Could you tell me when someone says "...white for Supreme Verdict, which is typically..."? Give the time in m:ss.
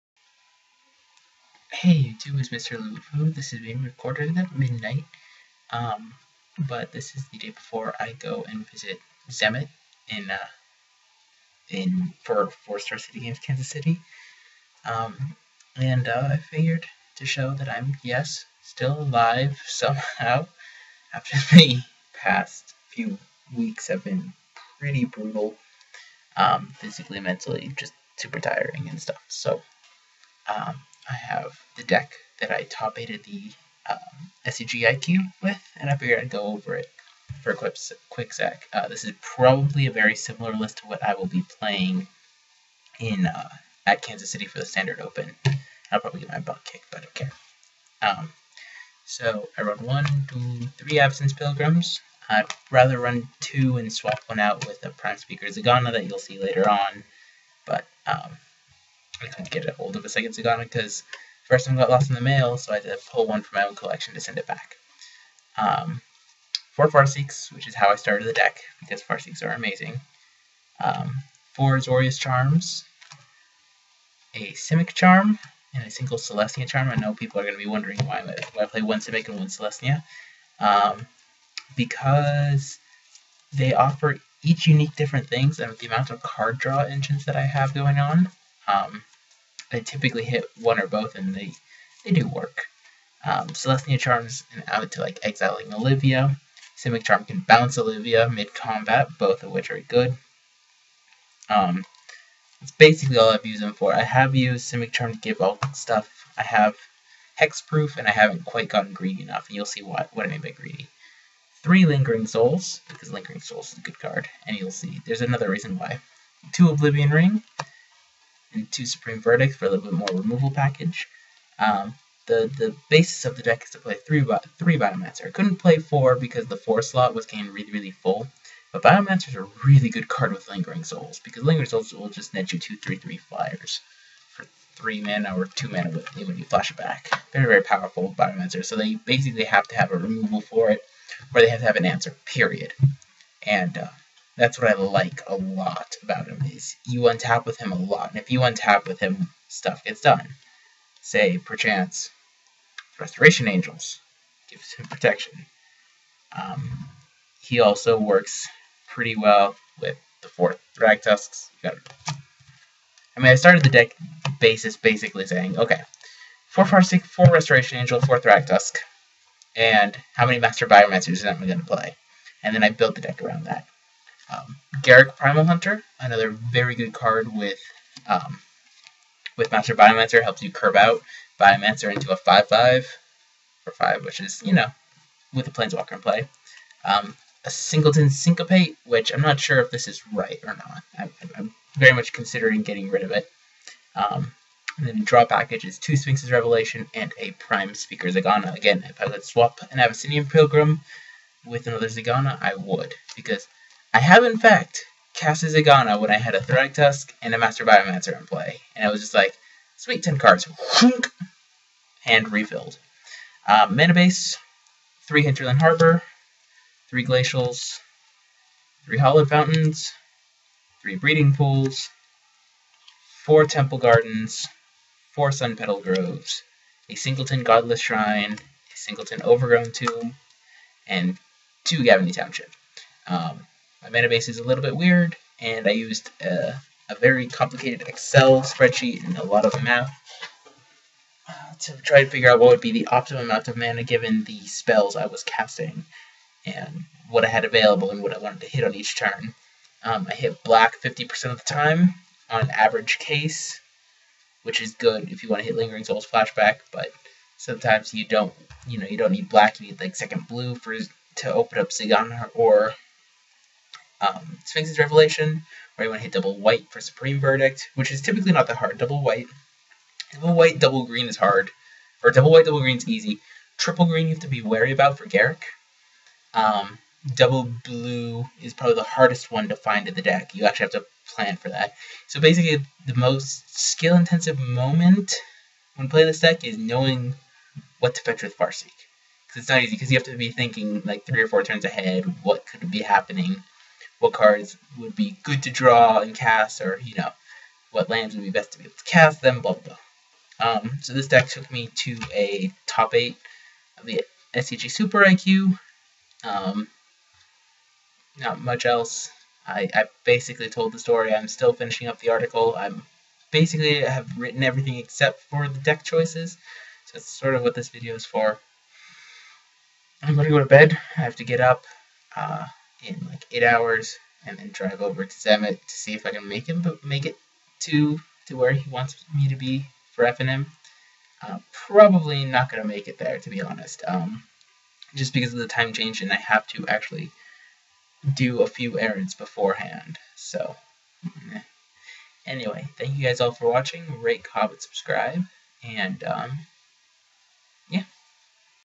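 4:26.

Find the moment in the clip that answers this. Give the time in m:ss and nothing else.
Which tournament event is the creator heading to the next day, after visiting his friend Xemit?
0:12.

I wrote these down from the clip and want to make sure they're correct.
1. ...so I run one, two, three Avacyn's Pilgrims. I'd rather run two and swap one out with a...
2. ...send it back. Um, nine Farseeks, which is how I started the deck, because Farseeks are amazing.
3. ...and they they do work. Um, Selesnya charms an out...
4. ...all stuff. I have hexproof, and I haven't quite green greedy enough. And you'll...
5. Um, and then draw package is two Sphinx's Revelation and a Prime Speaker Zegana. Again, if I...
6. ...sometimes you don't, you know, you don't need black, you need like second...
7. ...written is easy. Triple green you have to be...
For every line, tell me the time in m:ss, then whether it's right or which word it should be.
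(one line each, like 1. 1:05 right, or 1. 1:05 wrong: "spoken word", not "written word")
1. 0:49 right
2. 1:04 wrong: "four", not "nine"
3. 1:31 right
4. 1:45 wrong: "gotten", not "green"
5. 3:13 right
6. 4:17 right
7. 4:32 wrong: "green", not "written".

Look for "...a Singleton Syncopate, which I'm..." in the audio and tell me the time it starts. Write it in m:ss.
3:07.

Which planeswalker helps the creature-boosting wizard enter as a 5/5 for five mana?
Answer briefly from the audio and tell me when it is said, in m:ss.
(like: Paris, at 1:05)
Garruk Primal Hunter, at 2:54.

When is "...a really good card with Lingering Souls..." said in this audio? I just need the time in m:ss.
2:09.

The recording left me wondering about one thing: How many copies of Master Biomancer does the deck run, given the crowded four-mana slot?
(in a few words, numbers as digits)
3.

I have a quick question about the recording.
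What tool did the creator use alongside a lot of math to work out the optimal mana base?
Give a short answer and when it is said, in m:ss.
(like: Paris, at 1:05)
Excel spreadsheet, at 3:57.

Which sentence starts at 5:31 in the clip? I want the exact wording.
Uh, probably not gonna make it there to be honest.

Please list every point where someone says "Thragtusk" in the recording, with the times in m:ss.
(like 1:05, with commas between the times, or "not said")
2:40, 2:48, 3:26.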